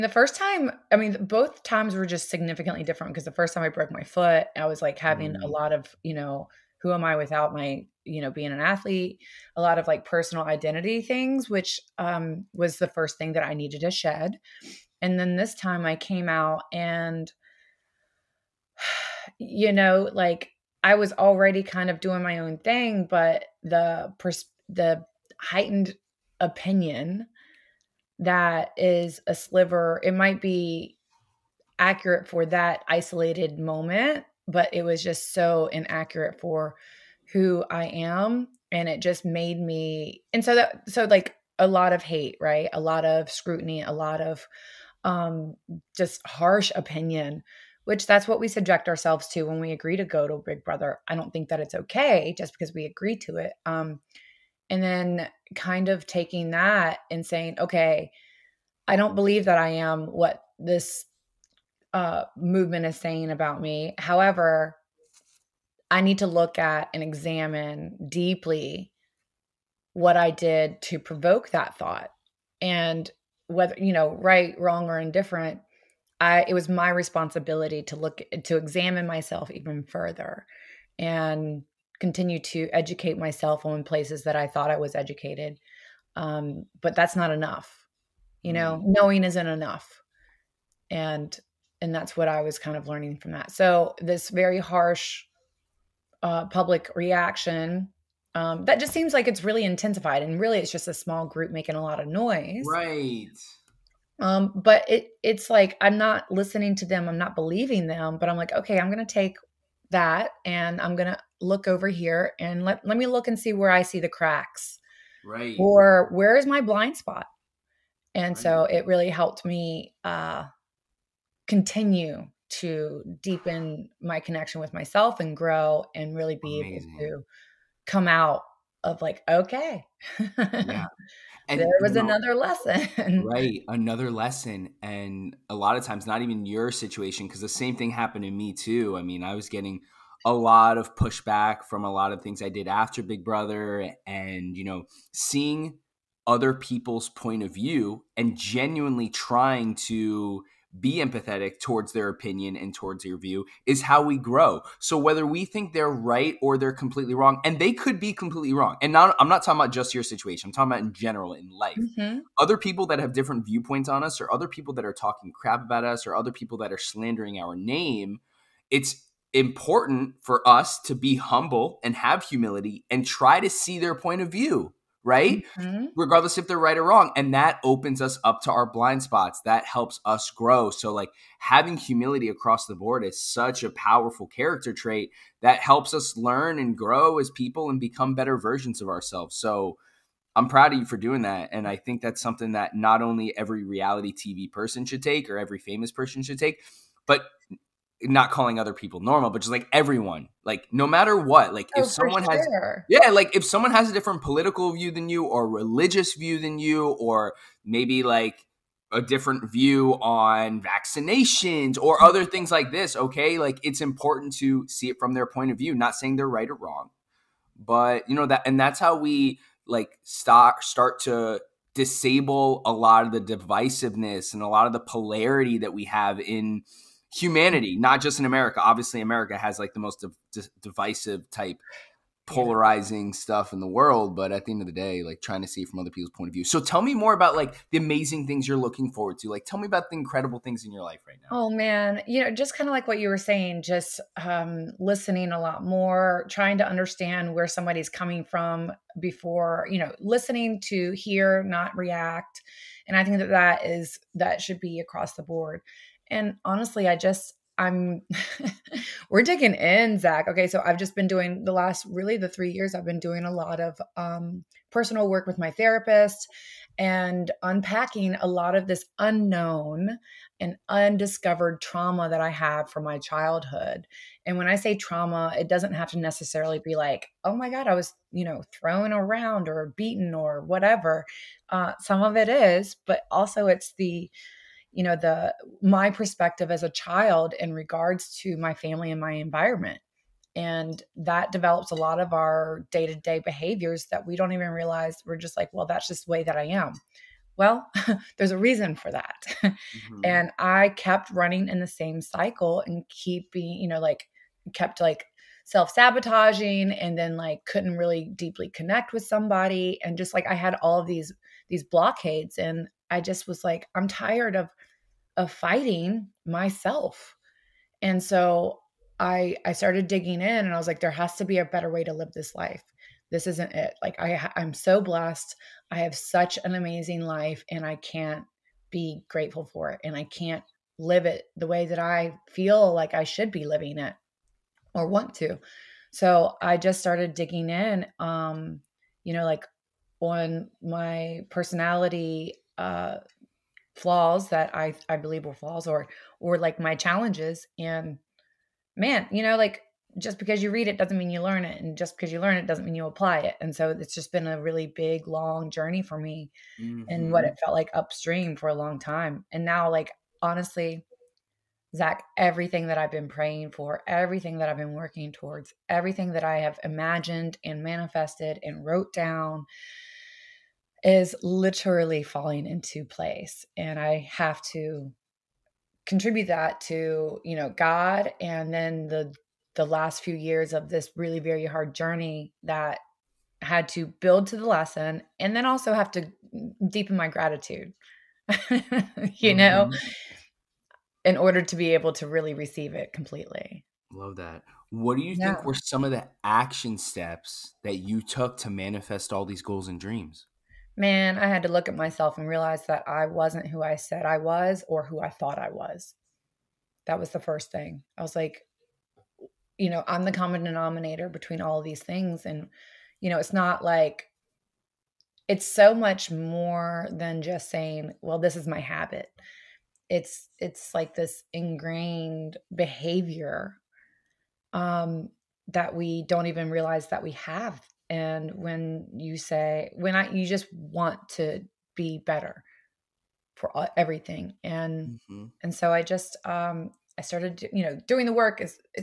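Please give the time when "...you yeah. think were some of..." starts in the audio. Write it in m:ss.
6:35.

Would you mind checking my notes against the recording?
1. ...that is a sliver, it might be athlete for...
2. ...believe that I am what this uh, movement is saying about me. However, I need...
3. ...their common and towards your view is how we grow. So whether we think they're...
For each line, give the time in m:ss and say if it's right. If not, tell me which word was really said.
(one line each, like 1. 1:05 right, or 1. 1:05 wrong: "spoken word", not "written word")
1. 0:28 wrong: "accurate", not "athlete"
2. 0:59 right
3. 2:31 wrong: "opinion", not "common".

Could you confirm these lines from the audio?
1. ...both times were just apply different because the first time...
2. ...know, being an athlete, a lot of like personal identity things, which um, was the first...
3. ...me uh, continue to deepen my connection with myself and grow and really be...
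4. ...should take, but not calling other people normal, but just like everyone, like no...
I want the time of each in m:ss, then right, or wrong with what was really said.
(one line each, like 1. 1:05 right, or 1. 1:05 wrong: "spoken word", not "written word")
1. 0:01 wrong: "significantly", not "apply"
2. 0:08 right
3. 1:59 right
4. 3:16 right.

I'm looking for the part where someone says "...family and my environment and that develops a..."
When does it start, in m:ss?
4:48.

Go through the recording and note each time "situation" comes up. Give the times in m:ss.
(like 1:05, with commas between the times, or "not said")
2:16, 2:40.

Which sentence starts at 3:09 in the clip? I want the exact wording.
So, I'm proud of you for doing that.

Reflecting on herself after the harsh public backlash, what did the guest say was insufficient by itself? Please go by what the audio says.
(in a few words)
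Knowing.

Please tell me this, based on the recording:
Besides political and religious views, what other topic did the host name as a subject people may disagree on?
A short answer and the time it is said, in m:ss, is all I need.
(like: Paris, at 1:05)
Vaccinations, at 3:30.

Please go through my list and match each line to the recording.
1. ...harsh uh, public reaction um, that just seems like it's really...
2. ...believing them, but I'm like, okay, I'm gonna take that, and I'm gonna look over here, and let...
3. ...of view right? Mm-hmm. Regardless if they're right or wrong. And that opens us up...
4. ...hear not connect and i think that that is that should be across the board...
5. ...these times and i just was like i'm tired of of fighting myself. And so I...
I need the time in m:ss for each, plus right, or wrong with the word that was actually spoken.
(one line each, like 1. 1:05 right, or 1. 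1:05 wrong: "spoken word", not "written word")
1. 1:34 right
2. 1:47 right
3. 2:54 right
4. 4:10 wrong: "react", not "connect"
5. 5:11 wrong: "blockades", not "times".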